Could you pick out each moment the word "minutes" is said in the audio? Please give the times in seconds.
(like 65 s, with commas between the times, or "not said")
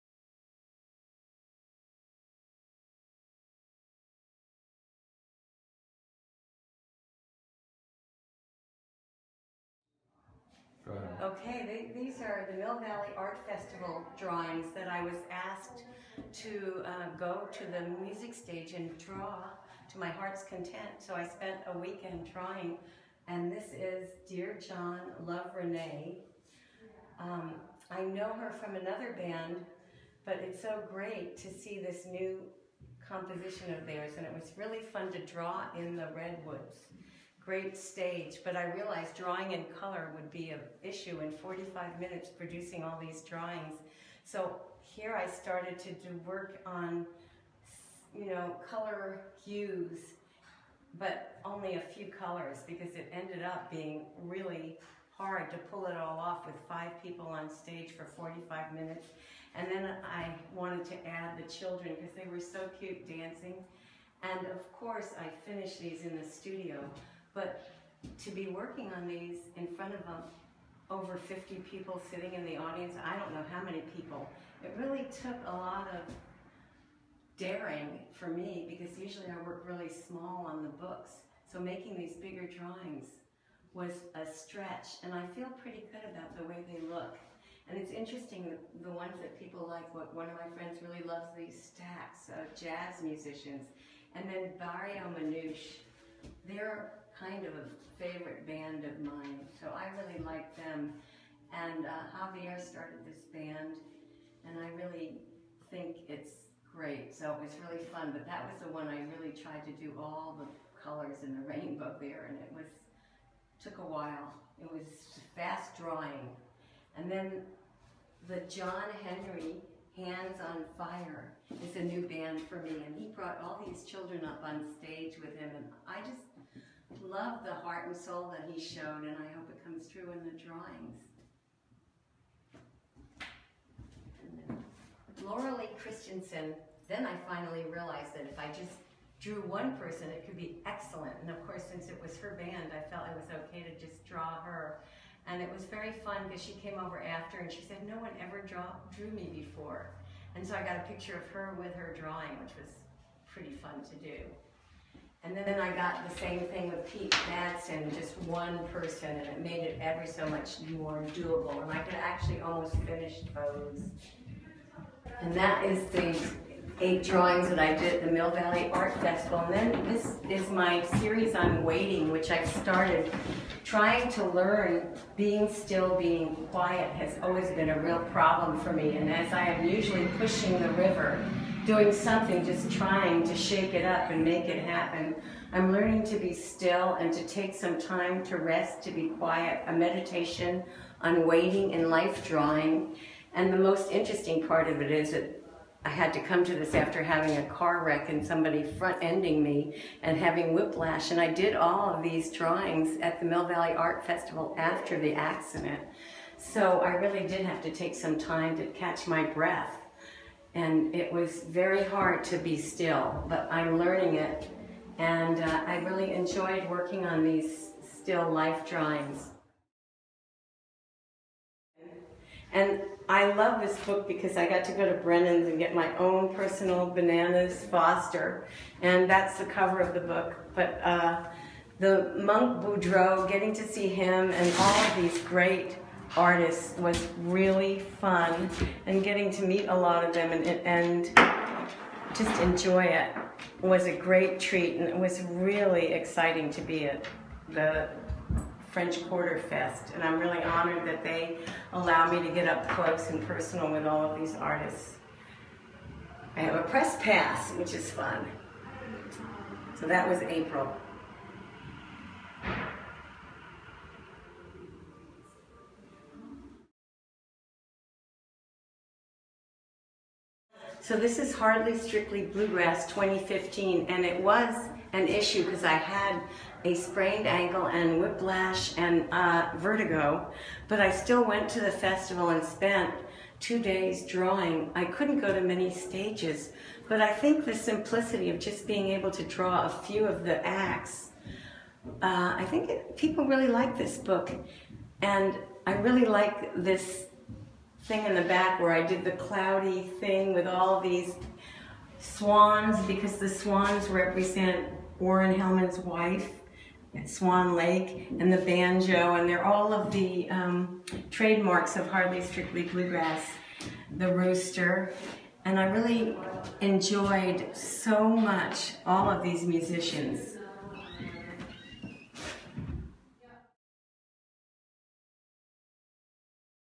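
41 s, 58 s.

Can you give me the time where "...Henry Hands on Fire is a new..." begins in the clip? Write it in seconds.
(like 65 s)
119 s.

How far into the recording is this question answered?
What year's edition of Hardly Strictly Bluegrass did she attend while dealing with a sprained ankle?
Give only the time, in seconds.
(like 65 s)
272 s.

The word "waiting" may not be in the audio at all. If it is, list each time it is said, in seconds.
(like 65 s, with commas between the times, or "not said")
171 s, 191 s.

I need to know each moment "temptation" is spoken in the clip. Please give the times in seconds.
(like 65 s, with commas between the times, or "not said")
not said.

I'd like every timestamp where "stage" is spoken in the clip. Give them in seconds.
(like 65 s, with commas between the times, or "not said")
18 s, 37 s, 57 s, 124 s, 285 s.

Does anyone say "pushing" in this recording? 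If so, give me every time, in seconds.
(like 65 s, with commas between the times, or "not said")
180 s.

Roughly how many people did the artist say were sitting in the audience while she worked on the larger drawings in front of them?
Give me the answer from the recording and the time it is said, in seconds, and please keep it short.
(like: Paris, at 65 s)
over 50, at 70 s.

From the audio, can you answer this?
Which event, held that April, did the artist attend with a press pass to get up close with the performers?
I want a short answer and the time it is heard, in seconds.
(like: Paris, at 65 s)
French Quarter Fest, at 248 s.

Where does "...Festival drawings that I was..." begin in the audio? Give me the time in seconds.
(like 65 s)
13 s.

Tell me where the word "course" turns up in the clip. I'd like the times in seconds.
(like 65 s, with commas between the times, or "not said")
64 s, 141 s.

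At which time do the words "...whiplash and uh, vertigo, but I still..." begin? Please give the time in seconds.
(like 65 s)
278 s.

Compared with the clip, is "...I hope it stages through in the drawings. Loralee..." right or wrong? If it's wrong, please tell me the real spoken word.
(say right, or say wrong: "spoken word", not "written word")
wrong: "comes", not "stages".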